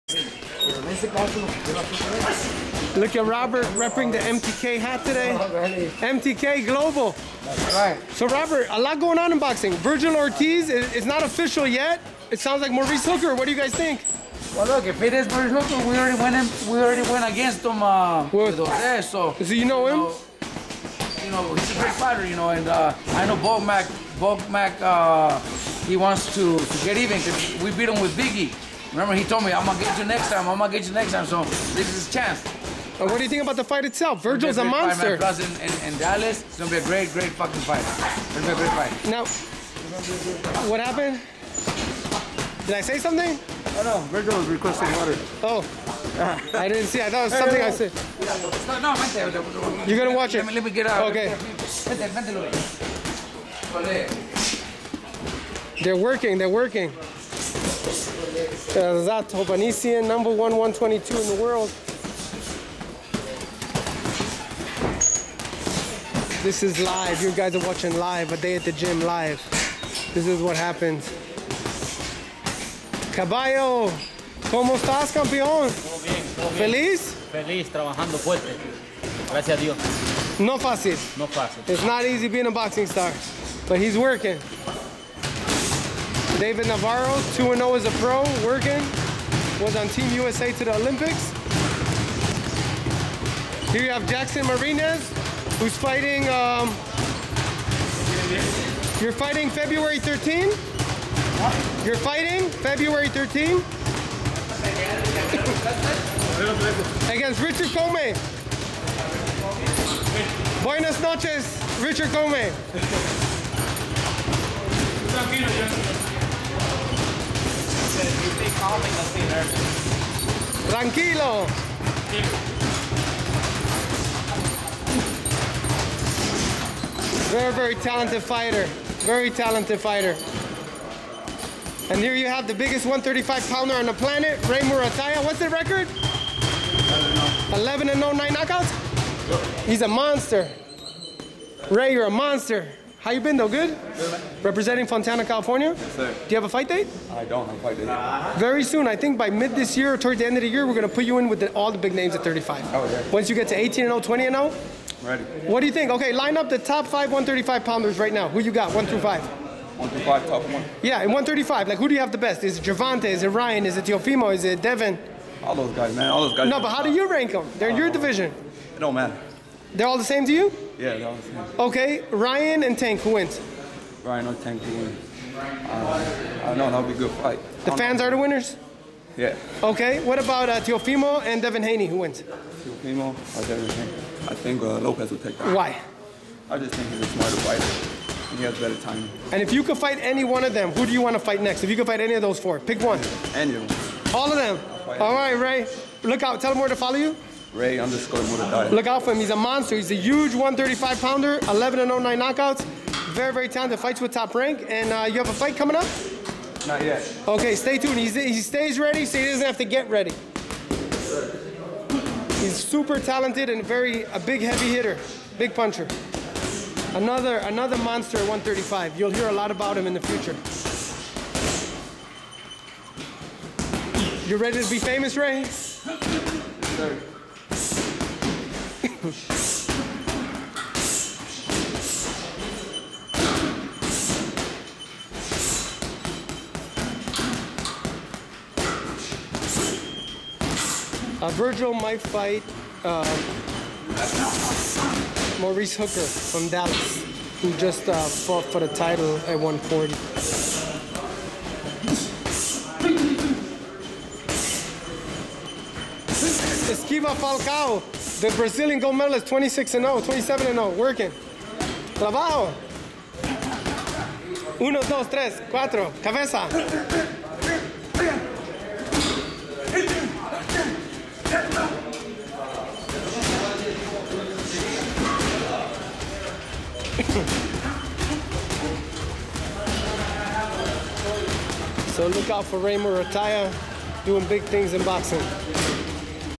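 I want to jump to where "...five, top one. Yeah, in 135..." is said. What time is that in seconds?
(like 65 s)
160 s.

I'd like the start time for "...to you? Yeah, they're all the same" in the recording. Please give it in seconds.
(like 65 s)
170 s.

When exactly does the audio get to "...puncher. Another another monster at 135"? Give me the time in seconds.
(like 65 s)
215 s.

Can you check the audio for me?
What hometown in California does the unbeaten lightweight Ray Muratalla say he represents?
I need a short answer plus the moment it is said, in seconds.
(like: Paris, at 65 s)
Fontana, California, at 144 s.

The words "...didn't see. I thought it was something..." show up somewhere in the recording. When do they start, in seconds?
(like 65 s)
46 s.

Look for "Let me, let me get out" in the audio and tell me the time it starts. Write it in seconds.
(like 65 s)
50 s.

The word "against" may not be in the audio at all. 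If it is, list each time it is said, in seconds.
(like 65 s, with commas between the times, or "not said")
17 s, 107 s.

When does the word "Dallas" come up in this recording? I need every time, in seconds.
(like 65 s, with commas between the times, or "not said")
35 s, 246 s.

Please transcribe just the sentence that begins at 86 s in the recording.
David Navarro, 2 0 as a pro, working.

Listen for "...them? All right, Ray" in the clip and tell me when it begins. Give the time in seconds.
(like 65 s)
194 s.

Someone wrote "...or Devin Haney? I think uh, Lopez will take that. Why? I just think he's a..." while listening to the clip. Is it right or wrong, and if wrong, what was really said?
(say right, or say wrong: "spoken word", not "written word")
right.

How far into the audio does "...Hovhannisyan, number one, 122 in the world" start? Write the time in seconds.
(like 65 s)
59 s.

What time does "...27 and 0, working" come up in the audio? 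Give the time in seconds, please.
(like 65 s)
260 s.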